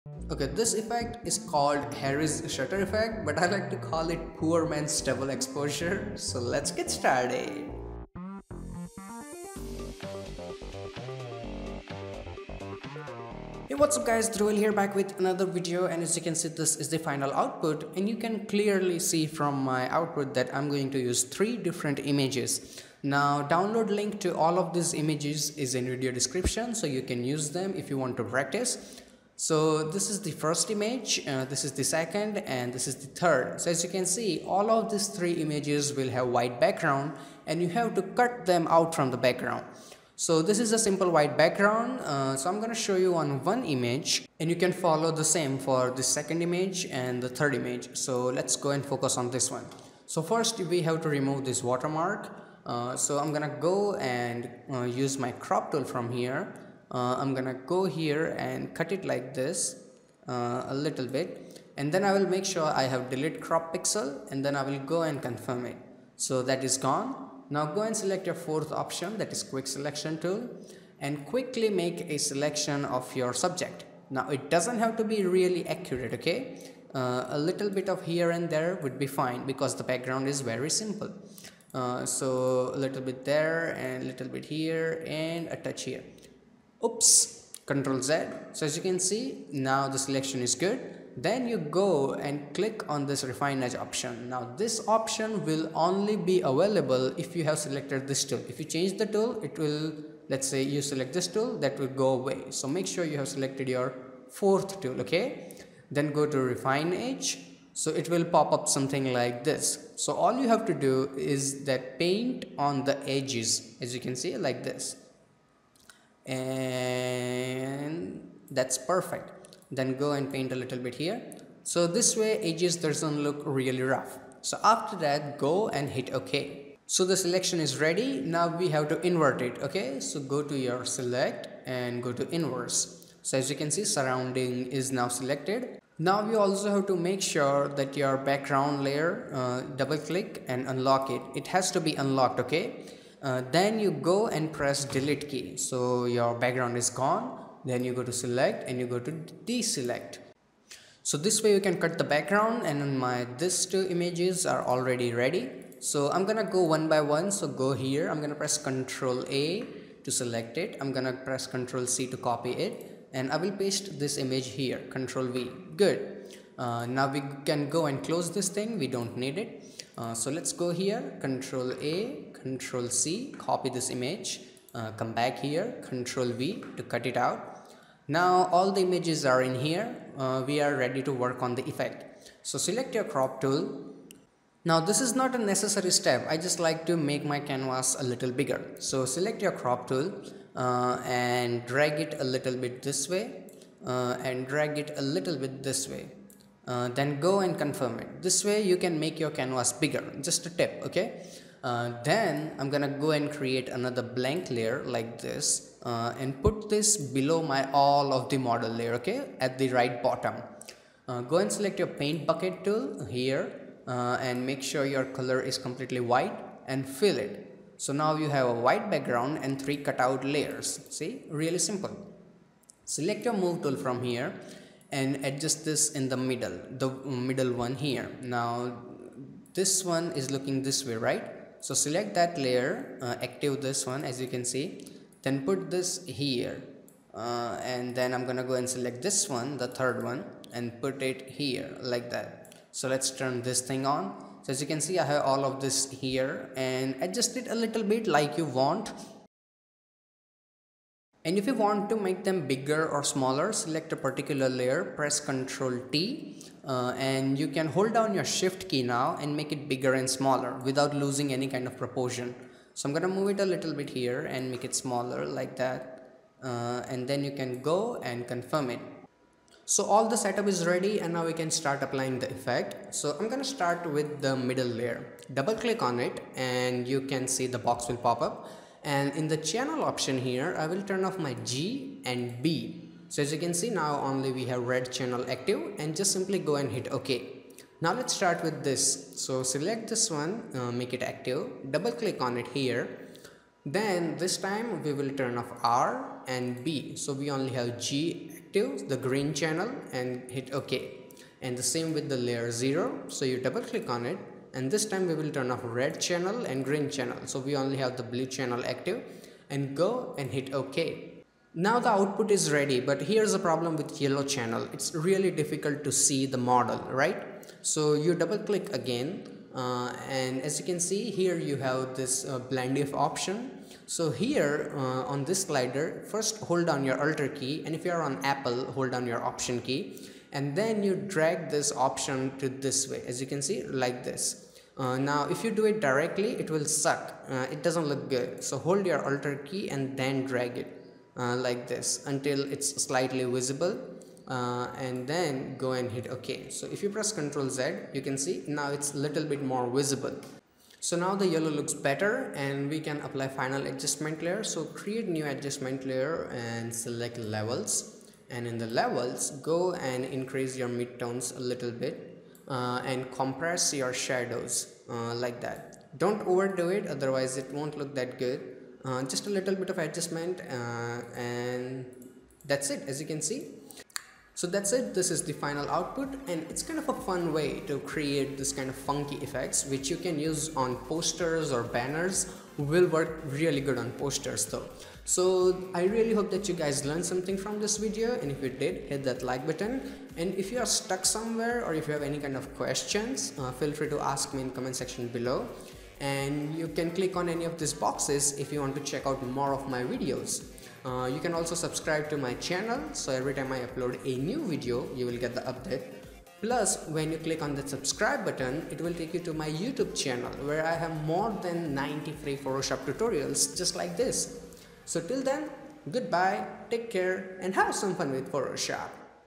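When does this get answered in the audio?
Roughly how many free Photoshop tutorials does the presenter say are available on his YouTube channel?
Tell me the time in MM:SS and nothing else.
06:51.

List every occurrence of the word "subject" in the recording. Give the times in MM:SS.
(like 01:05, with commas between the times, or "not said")
01:13.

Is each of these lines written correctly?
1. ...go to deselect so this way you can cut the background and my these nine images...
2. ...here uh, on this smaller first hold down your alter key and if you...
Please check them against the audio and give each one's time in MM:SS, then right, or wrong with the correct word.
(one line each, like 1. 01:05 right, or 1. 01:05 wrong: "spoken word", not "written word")
1. 02:28 wrong: "two", not "nine"
2. 05:24 wrong: "slider", not "smaller".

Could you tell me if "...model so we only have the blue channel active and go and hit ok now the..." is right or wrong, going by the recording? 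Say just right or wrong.
wrong.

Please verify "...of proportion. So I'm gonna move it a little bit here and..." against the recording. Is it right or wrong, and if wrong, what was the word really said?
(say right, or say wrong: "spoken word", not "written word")
right.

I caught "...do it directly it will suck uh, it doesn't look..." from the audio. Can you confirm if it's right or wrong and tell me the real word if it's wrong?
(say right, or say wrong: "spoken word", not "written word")
right.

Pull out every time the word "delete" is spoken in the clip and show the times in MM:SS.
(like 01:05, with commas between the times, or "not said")
01:03, 02:24.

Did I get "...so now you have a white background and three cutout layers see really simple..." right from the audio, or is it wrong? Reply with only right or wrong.
right.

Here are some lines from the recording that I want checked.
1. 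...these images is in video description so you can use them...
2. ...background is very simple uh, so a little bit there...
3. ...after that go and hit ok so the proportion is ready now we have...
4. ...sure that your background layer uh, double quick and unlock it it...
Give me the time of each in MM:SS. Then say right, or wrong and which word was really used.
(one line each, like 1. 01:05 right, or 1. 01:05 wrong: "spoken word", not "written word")
1. 00:24 right
2. 01:19 right
3. 02:04 wrong: "selection", not "proportion"
4. 02:17 wrong: "click", not "quick".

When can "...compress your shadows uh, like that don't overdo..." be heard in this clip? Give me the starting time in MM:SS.
06:03.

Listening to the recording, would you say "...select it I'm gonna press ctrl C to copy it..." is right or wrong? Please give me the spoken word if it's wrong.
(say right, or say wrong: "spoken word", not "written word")
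right.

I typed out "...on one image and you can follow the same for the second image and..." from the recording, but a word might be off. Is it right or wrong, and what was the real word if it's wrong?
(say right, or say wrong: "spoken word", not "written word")
right.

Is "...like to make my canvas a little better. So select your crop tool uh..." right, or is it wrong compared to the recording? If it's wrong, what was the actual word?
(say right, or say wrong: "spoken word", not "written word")
wrong: "bigger", not "better".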